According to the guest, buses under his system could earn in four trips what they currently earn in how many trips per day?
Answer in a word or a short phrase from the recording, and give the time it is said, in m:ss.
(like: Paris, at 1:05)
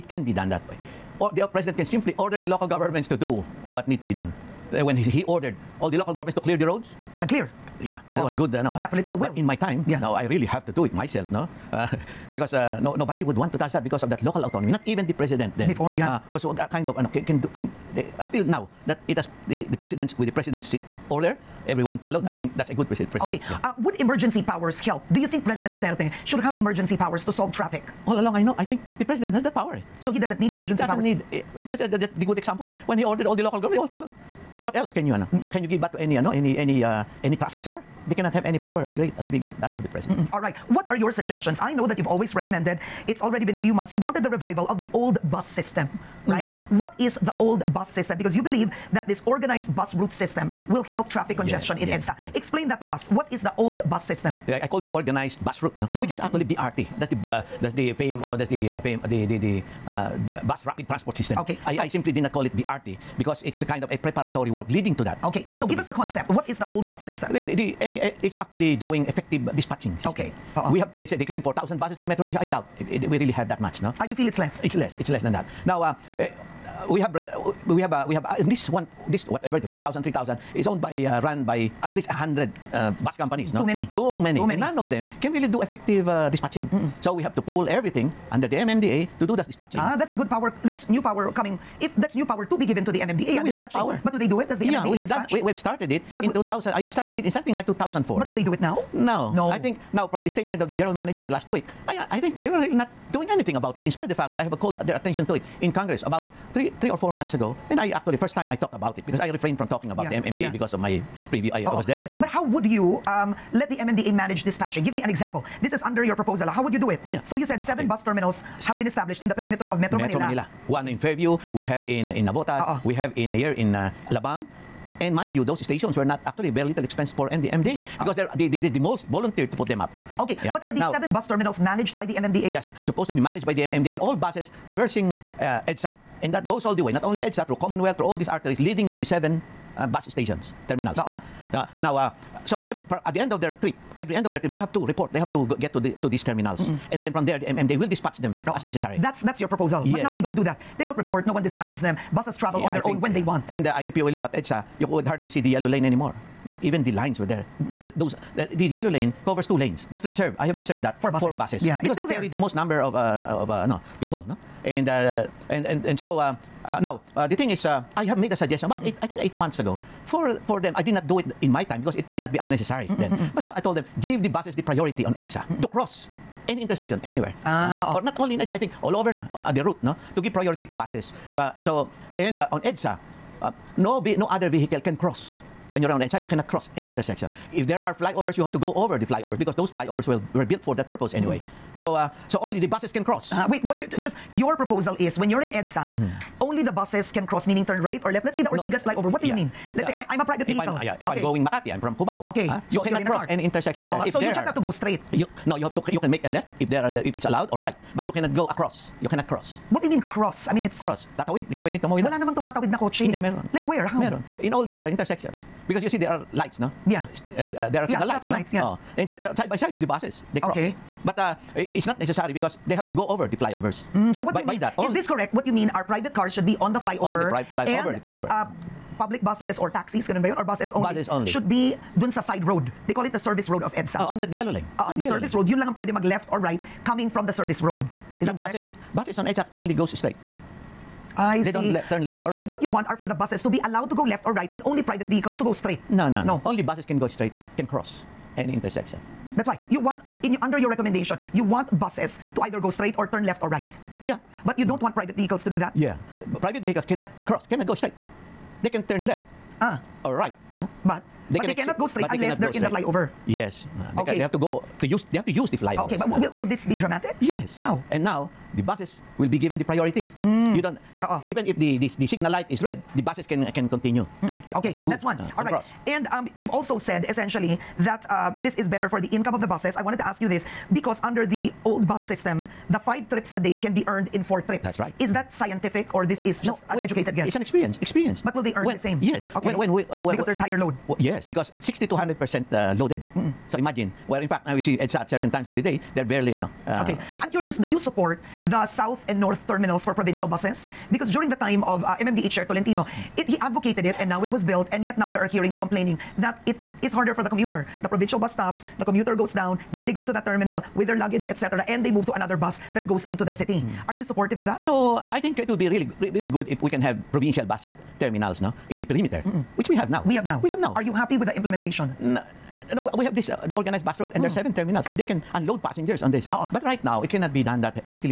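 5, at 4:42.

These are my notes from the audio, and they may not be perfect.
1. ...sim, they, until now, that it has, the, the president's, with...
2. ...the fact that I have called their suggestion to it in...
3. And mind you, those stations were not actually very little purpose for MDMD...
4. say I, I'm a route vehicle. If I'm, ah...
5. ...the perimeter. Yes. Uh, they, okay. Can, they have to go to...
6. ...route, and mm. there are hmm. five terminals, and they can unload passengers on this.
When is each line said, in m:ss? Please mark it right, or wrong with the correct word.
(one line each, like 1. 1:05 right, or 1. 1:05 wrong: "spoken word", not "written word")
1. 0:17 right
2. 1:44 wrong: "attention", not "suggestion"
3. 2:05 wrong: "expense", not "purpose"
4. 3:19 wrong: "private", not "route"
5. 4:22 wrong: "flyover", not "perimeter"
6. 5:24 wrong: "seven", not "five".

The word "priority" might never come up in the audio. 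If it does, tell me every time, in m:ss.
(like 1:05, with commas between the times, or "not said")
2:54, 3:00, 4:29.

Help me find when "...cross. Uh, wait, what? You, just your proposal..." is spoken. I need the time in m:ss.
3:13.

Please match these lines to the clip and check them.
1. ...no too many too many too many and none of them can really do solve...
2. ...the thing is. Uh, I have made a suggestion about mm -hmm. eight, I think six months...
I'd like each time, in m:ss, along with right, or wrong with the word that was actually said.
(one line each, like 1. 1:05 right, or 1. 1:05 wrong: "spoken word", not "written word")
1. 1:23 wrong: "effective", not "solve"
2. 2:47 wrong: "eight", not "six".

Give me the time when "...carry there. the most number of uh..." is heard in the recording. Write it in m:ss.
2:42.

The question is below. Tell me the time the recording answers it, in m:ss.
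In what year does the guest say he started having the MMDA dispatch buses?
1:37.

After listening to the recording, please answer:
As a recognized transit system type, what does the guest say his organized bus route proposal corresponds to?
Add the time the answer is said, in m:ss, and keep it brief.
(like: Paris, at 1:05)
bus rapid transport system, at 1:00.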